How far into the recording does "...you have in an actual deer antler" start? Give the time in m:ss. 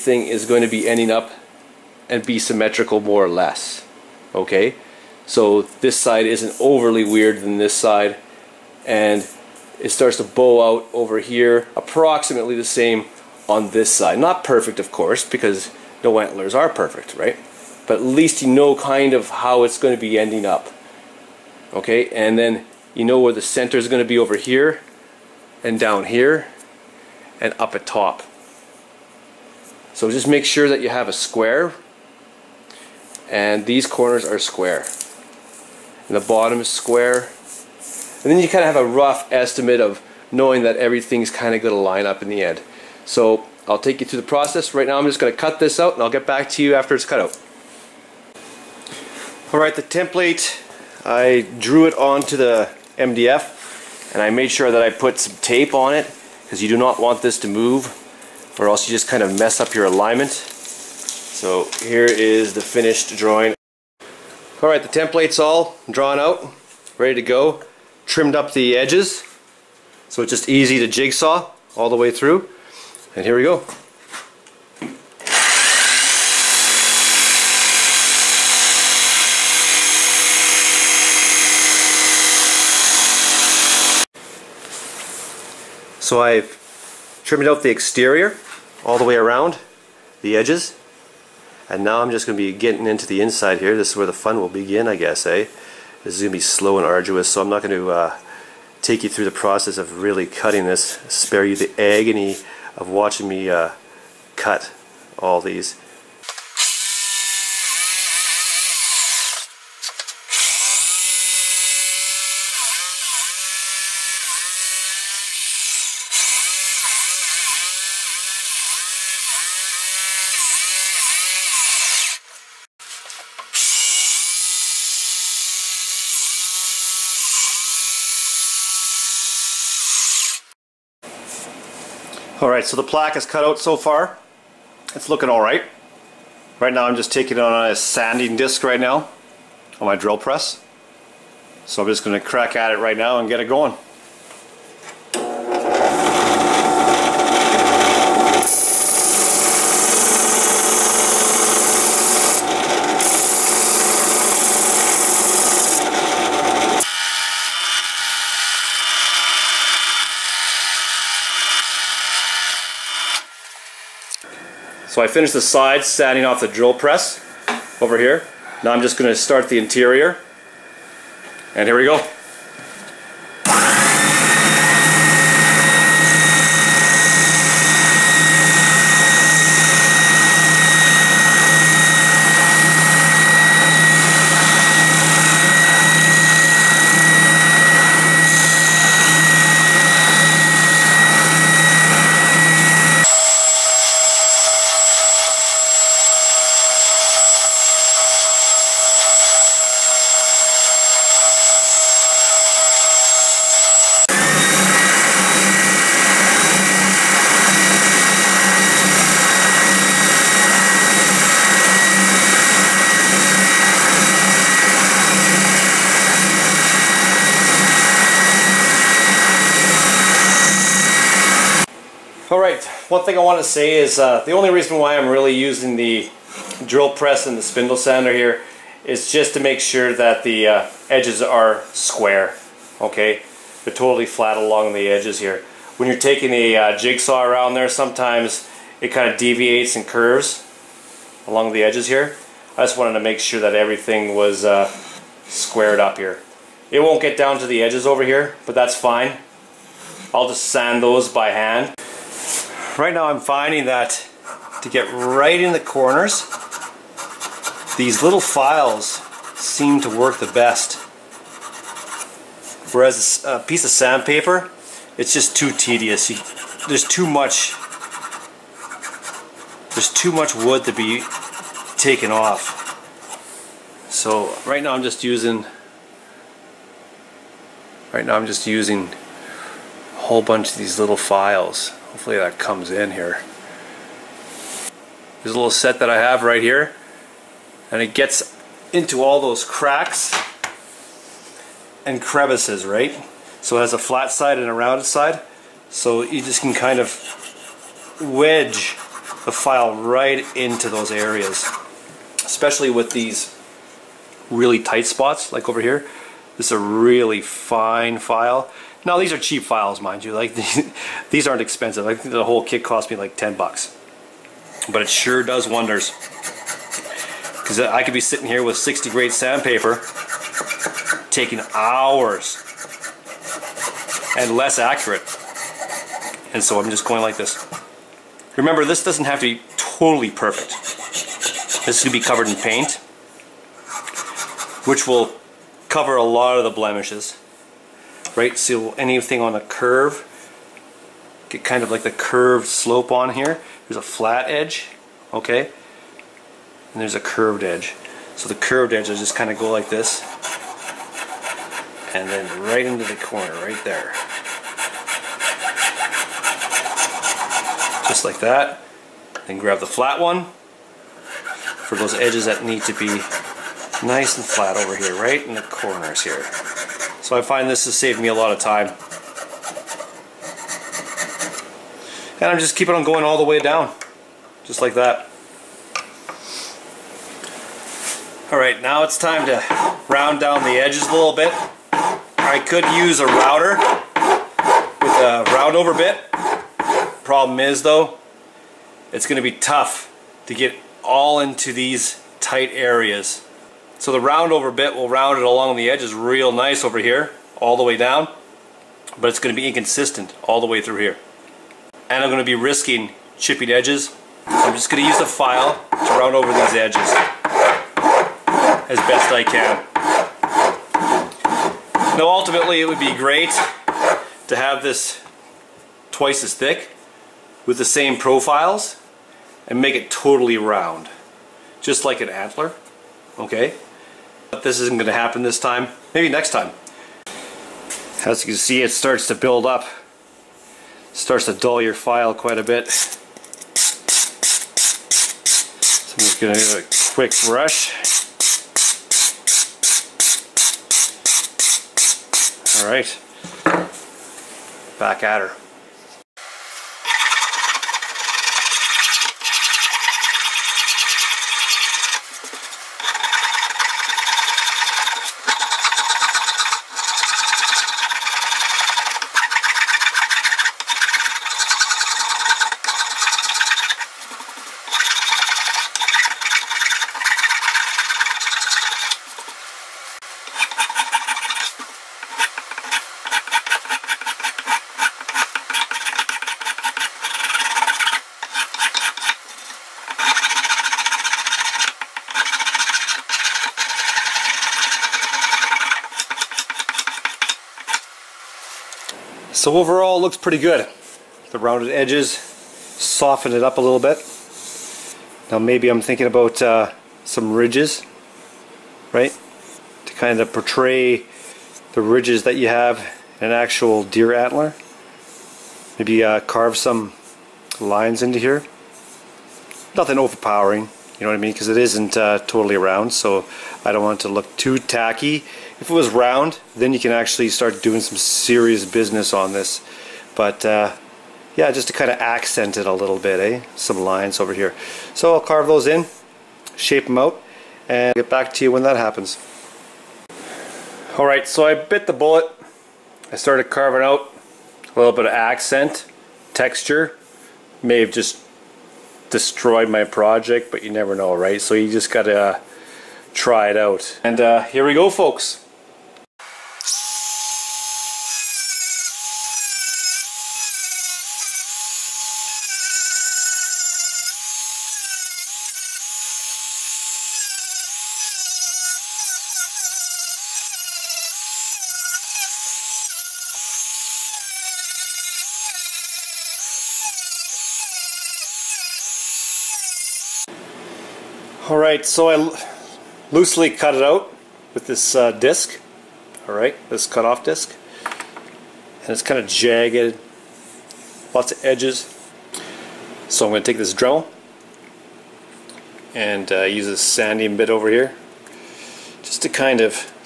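8:22.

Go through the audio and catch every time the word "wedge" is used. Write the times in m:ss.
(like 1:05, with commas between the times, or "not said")
4:58.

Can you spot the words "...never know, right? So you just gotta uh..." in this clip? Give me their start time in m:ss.
9:00.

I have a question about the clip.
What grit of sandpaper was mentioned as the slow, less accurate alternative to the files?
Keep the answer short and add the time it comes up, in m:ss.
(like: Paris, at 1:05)
60, at 5:18.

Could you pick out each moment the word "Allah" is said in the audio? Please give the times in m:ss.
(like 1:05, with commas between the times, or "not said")
not said.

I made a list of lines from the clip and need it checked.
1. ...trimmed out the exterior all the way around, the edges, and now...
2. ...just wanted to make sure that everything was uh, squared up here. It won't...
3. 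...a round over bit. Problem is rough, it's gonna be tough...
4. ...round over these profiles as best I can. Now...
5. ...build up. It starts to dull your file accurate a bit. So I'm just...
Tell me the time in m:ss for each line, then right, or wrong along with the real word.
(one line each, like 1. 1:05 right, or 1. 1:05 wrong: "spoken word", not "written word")
1. 1:27 right
2. 4:02 right
3. 6:25 wrong: "though", not "rough"
4. 6:45 wrong: "edges", not "profiles"
5. 7:09 wrong: "quite", not "accurate".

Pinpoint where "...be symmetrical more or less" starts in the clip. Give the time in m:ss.
0:02.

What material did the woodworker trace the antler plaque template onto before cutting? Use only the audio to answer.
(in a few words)
MDF.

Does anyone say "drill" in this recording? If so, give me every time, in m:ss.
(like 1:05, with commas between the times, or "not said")
2:19, 2:46, 3:46.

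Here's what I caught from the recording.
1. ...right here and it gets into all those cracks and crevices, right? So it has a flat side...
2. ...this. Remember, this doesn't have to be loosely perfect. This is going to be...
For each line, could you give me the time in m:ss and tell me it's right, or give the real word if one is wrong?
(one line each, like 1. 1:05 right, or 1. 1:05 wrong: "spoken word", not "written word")
1. 4:46 right
2. 5:27 wrong: "totally", not "loosely".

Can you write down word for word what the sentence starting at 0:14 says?
Not perfect of course because no antlers are perfect, right?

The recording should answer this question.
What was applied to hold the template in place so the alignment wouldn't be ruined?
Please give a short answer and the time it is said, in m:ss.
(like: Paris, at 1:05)
Tape, at 0:55.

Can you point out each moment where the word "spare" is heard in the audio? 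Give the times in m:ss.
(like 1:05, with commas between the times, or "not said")
1:41.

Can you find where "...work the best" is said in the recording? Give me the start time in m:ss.
4:19.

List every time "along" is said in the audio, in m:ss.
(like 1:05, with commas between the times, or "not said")
3:54, 4:01, 6:35.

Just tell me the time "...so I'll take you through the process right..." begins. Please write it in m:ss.
0:43.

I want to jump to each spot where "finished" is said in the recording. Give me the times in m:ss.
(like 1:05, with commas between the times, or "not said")
1:02, 2:45.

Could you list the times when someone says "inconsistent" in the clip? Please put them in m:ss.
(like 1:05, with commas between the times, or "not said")
6:39.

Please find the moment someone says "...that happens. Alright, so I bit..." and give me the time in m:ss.
8:48.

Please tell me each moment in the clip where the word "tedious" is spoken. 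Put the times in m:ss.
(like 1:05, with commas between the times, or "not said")
4:25.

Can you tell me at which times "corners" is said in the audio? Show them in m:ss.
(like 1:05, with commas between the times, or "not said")
0:33, 4:15, 5:52, 6:05.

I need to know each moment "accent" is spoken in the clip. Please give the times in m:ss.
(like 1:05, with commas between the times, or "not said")
8:42, 8:55.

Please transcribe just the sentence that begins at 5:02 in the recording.
Especially with these really tight spots, like over here.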